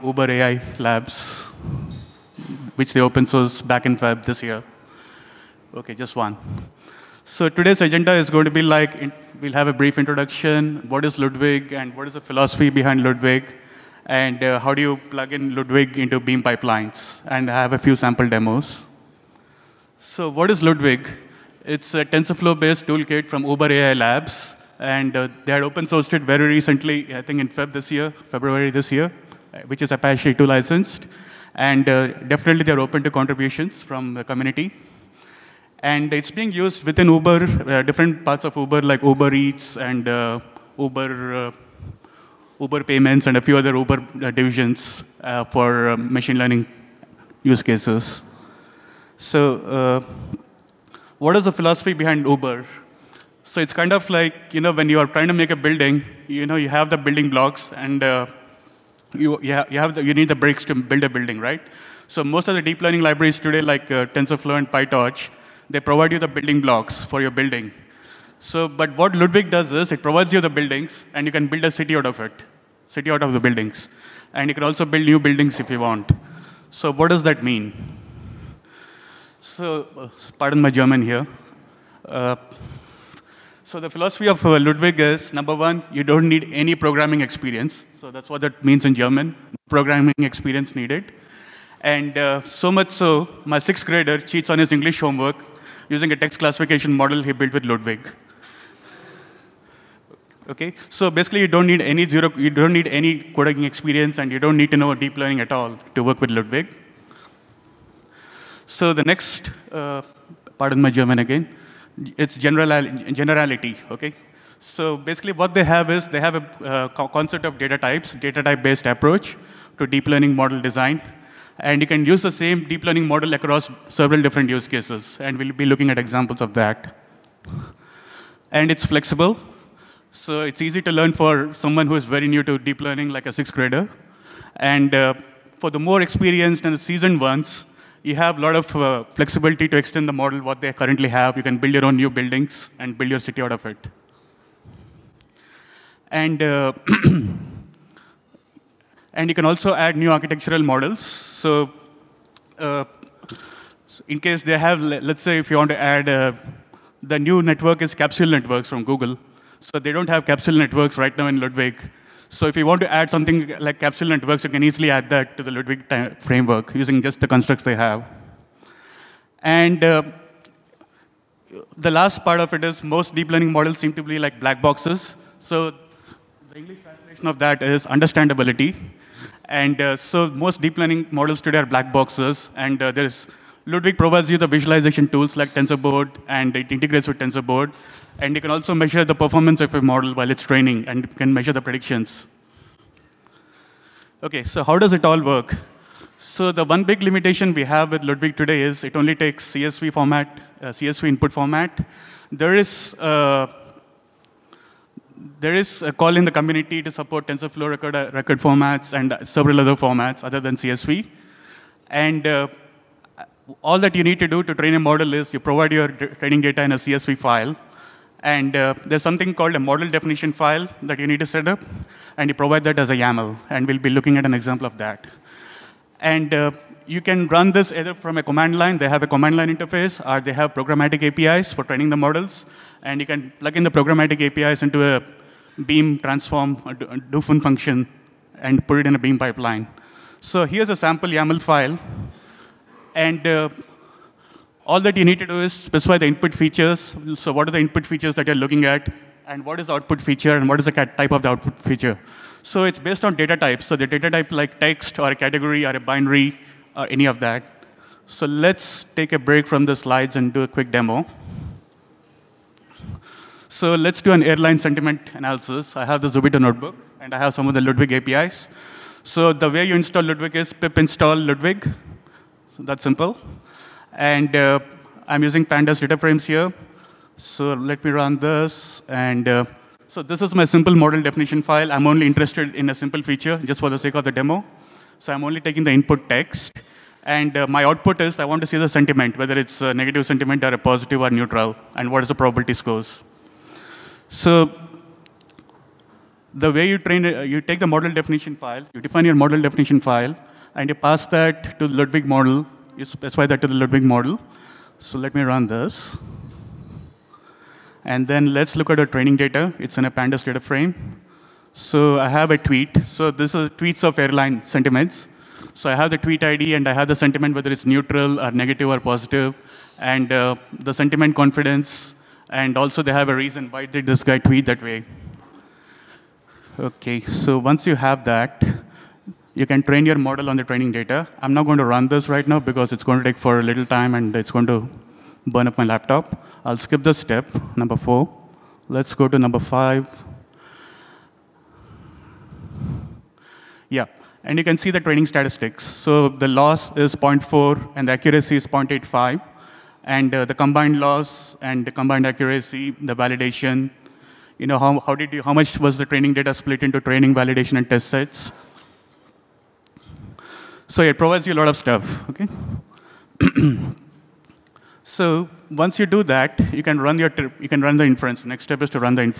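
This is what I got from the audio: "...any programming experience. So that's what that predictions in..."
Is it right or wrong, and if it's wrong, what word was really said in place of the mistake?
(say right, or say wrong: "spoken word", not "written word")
wrong: "means", not "predictions".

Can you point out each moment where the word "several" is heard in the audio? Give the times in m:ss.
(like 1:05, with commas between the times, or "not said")
2:03, 3:29.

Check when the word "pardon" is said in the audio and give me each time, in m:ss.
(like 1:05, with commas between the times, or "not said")
1:20, 1:50.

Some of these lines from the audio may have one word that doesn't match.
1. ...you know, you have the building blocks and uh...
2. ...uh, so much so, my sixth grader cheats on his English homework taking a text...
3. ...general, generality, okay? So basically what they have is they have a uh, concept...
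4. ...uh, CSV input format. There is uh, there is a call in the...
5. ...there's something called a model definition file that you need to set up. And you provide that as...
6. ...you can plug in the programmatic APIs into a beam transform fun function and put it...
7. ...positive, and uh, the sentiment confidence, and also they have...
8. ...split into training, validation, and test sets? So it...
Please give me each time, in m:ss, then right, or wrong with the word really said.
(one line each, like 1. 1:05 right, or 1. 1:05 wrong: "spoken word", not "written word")
1. 0:56 right
2. 1:32 wrong: "using", not "taking"
3. 1:52 right
4. 3:20 right
5. 3:38 right
6. 3:52 right
7. 5:18 right
8. 5:56 right.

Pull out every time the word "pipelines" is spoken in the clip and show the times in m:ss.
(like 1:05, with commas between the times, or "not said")
0:16, 3:59.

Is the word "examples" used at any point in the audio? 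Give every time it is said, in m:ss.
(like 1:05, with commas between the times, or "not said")
2:05, 3:44.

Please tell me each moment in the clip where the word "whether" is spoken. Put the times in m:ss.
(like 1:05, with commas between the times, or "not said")
4:49, 5:17.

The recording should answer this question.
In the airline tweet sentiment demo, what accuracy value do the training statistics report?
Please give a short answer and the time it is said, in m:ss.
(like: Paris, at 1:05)
0.85, at 5:48.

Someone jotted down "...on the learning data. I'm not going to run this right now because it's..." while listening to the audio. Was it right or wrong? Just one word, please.
wrong.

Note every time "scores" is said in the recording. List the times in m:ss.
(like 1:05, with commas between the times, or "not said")
4:52.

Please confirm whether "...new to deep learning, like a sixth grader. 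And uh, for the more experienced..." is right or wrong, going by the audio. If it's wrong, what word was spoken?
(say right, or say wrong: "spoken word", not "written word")
right.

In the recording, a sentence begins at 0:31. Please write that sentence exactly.
And uh, definitely they're open to contributions from the community.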